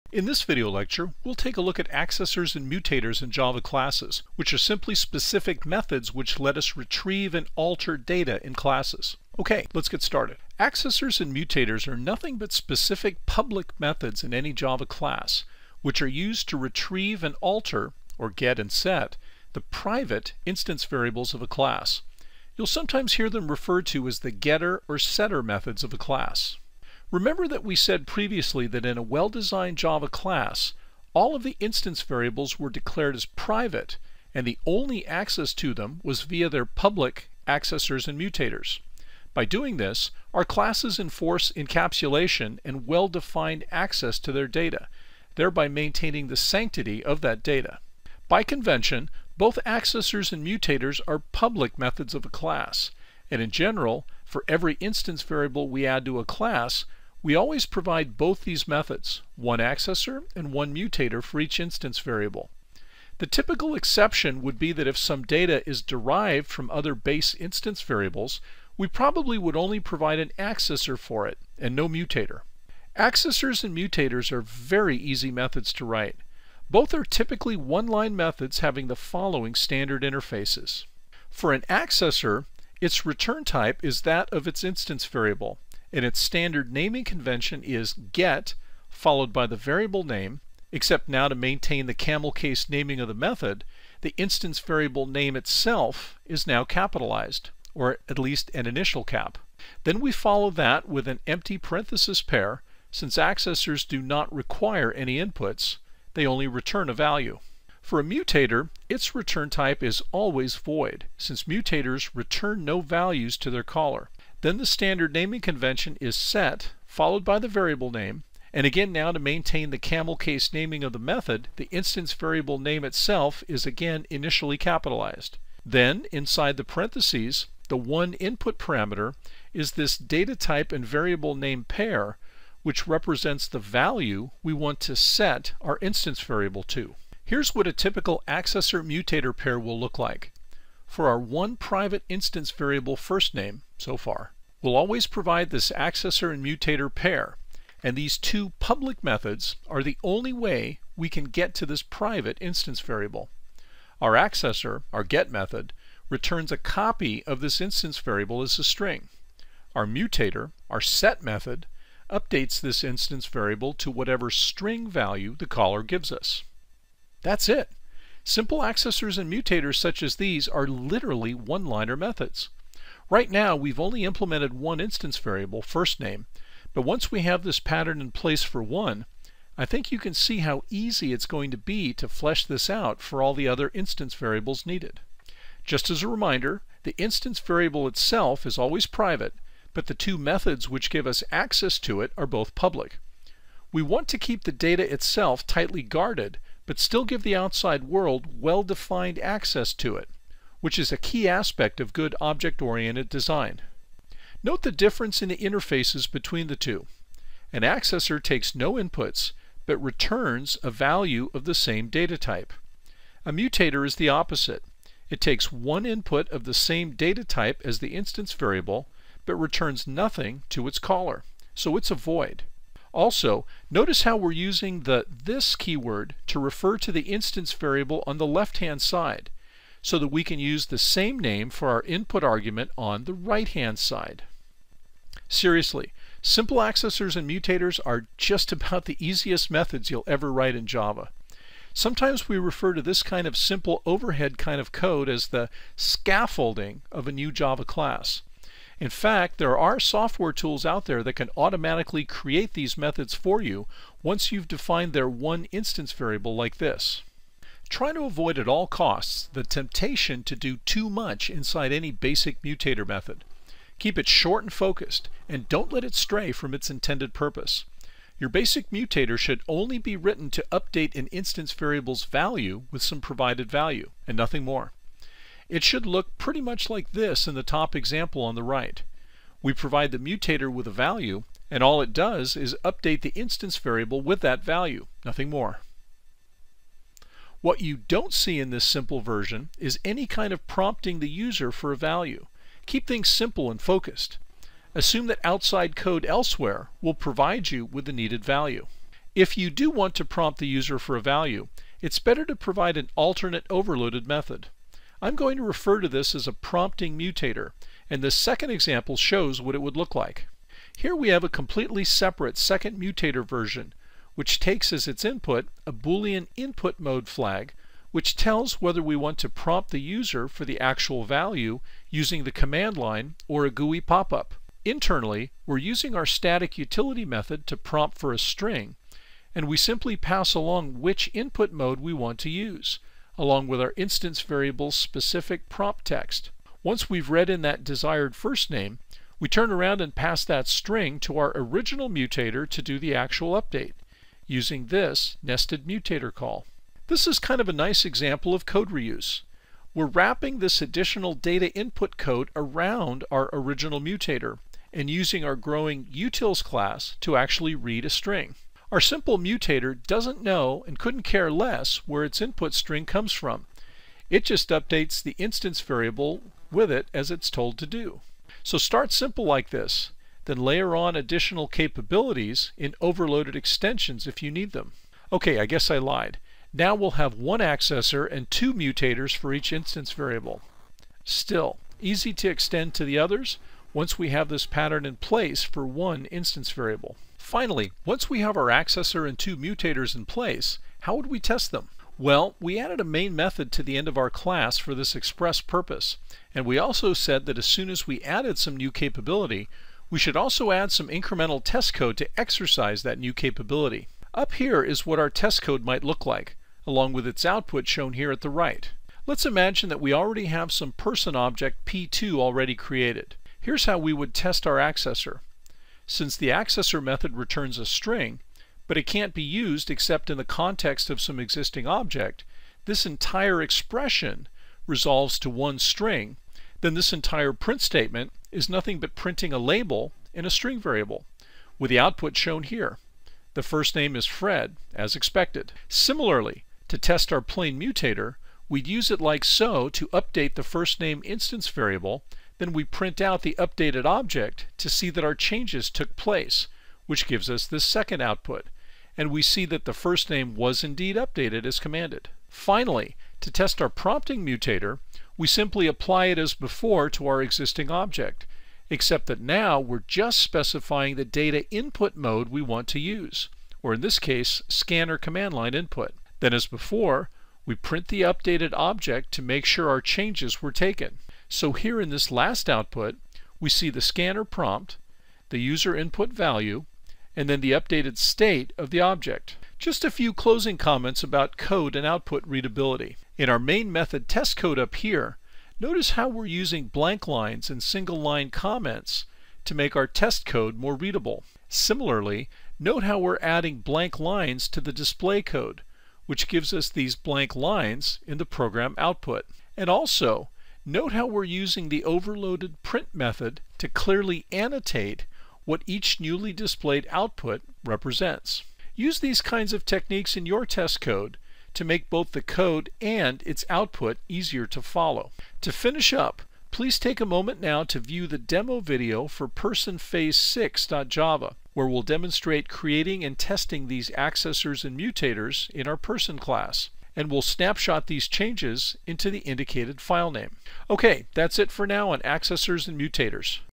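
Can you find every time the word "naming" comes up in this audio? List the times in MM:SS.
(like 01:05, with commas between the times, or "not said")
01:26, 01:32, 01:55, 02:00.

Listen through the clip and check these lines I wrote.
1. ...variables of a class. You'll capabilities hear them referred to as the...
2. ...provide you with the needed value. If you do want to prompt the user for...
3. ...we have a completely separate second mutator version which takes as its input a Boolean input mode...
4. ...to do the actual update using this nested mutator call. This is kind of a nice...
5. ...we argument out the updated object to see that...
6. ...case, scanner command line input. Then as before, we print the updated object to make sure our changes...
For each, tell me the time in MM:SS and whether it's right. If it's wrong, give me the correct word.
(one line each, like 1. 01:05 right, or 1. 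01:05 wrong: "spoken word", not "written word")
1. 00:20 wrong: "sometimes", not "capabilities"
2. 04:56 right
3. 05:10 right
4. 05:42 right
5. 07:22 wrong: "print", not "argument"
6. 07:43 right.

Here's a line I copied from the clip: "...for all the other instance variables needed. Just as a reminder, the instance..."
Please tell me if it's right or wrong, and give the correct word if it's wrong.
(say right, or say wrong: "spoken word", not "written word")
right.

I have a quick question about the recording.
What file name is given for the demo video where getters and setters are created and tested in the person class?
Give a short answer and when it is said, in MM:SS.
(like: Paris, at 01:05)
personphase6.java, at 08:39.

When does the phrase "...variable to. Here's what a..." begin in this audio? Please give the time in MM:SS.
02:16.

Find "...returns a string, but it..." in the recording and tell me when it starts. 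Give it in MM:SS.
06:57.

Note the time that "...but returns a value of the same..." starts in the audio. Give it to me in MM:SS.
03:29.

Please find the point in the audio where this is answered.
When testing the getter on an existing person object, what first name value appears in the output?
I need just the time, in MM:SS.
07:14.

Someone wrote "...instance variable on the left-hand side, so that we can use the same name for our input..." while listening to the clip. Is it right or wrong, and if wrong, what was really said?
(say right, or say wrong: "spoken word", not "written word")
right.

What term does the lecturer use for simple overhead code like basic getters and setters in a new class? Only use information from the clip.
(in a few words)
scaffolding.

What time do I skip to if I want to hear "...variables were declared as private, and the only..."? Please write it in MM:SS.
00:32.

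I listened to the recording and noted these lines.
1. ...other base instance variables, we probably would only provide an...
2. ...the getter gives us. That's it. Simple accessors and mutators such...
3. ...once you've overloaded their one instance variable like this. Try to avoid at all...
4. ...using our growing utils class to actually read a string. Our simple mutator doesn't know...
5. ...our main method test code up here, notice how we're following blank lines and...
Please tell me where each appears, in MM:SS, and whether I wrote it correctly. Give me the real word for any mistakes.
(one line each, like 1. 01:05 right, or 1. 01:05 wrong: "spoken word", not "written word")
1. 01:06 right
2. 02:45 wrong: "caller", not "getter"
3. 04:14 wrong: "defined", not "overloaded"
4. 05:54 right
5. 08:03 wrong: "using", not "following".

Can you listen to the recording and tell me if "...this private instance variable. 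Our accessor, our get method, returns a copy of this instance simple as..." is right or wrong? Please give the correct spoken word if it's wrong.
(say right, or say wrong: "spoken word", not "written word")
wrong: "variable", not "simple".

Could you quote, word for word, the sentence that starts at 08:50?
Okay, that's it for now on accessors and mutators.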